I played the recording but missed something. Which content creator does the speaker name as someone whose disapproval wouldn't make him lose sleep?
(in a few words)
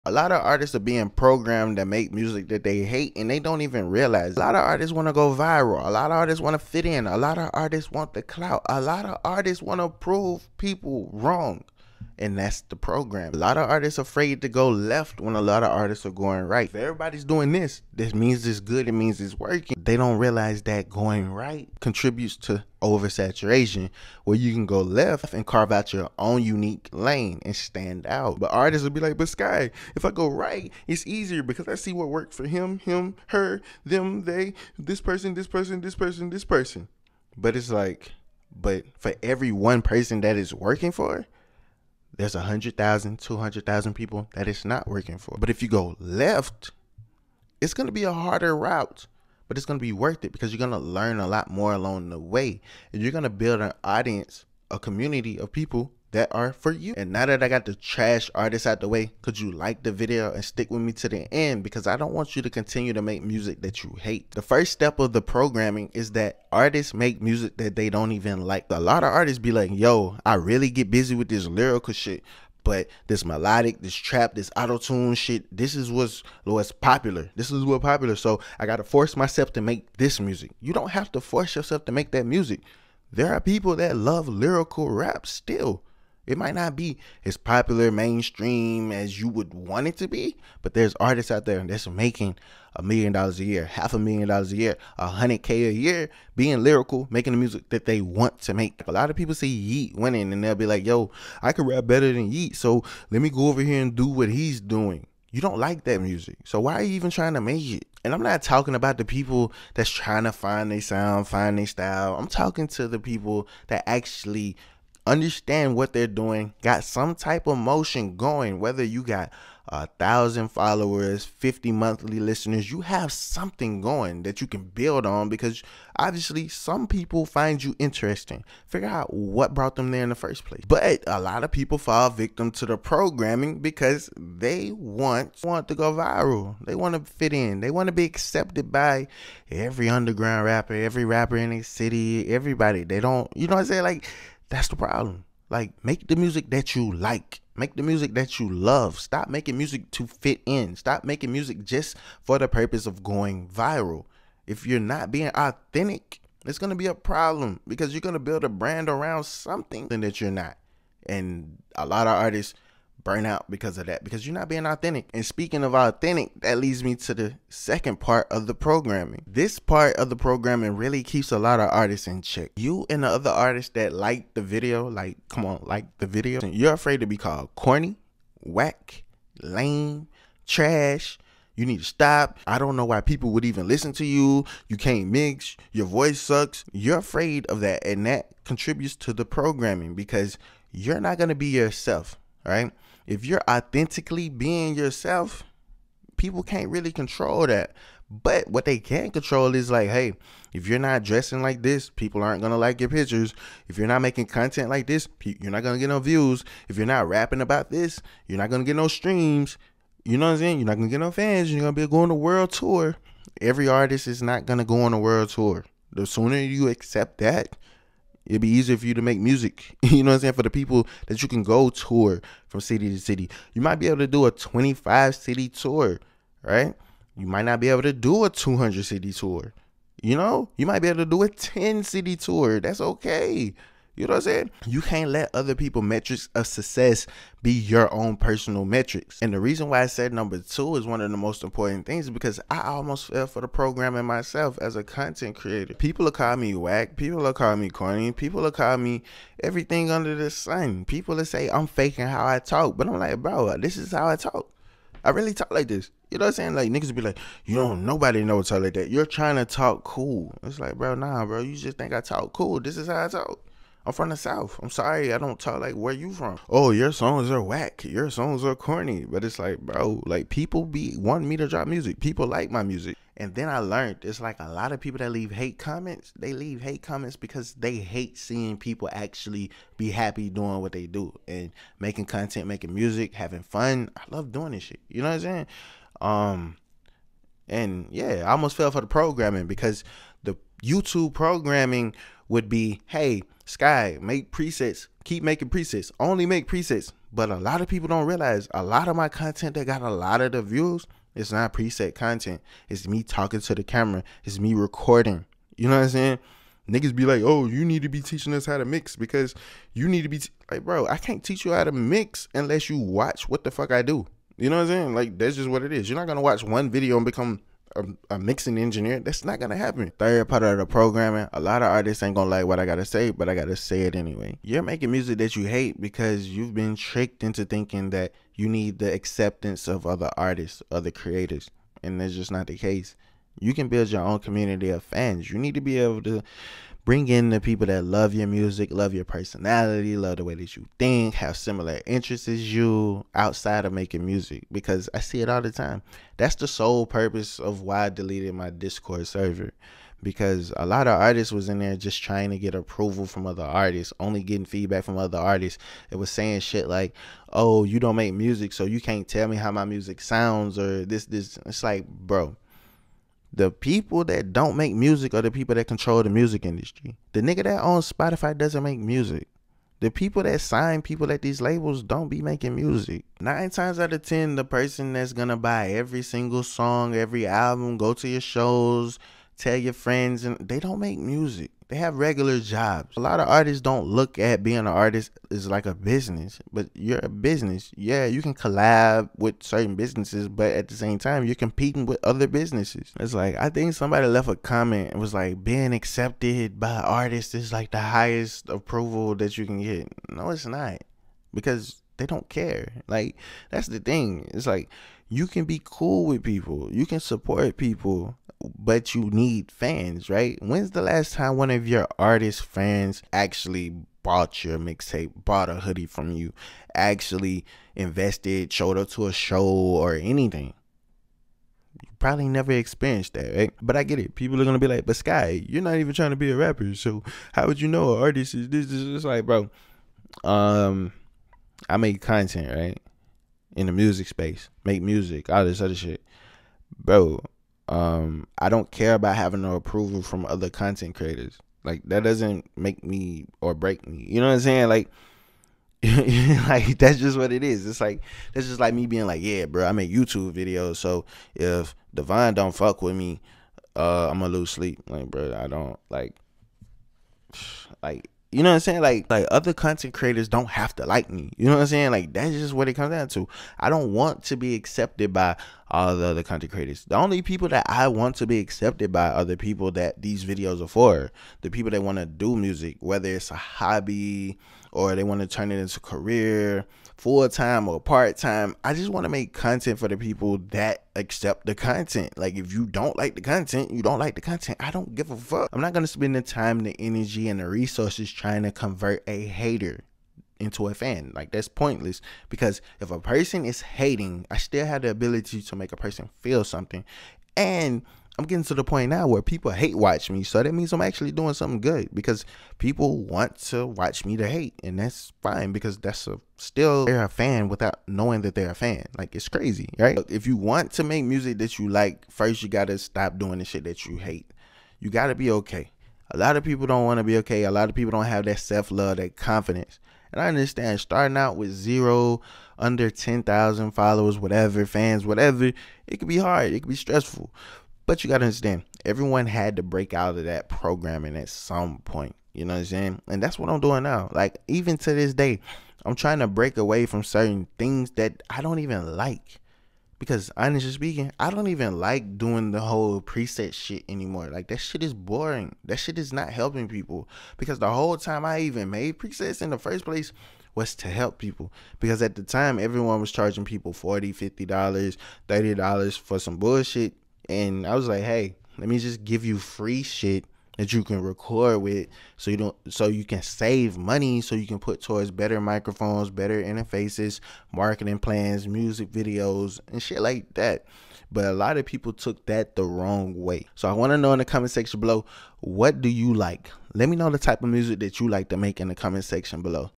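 Divine.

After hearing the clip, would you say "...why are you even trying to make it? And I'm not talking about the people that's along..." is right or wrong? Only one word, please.
wrong.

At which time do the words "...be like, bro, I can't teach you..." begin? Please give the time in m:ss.
5:10.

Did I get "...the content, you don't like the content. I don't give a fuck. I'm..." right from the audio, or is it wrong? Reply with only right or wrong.
right.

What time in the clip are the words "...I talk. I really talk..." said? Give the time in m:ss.
4:14.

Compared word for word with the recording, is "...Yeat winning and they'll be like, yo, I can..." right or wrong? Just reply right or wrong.
right.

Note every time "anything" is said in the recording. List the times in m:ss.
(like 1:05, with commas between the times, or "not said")
6:59.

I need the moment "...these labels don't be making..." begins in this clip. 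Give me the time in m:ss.
6:11.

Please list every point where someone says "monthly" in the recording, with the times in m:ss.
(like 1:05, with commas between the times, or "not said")
2:01.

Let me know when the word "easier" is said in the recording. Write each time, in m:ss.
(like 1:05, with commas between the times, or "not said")
0:31, 3:38.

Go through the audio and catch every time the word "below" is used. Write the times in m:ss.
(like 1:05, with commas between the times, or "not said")
9:34, 9:39.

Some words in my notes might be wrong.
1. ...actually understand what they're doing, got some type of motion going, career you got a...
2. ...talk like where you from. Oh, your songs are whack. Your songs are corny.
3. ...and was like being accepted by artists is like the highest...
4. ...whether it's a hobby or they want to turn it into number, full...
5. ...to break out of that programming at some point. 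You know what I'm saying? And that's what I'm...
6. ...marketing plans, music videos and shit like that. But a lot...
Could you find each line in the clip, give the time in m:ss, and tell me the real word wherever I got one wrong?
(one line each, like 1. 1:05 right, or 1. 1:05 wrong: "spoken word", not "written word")
1. 1:53 wrong: "whether", not "career"
2. 4:25 right
3. 6:34 right
4. 7:52 wrong: "career", not "number"
5. 8:49 right
6. 9:27 right.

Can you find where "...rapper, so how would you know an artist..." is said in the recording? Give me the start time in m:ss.
7:06.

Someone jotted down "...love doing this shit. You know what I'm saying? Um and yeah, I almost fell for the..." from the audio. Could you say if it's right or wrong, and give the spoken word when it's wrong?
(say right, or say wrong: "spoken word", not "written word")
right.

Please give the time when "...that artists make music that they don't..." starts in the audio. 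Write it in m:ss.
1:06.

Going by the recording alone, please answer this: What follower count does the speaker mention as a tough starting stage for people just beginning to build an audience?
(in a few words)
Under 10,000.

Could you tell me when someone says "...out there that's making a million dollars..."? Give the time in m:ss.
1:31.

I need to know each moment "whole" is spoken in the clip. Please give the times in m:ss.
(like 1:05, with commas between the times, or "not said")
9:02, 9:07.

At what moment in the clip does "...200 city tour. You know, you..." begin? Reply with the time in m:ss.
3:48.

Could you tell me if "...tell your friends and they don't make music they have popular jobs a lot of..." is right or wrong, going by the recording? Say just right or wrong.
wrong.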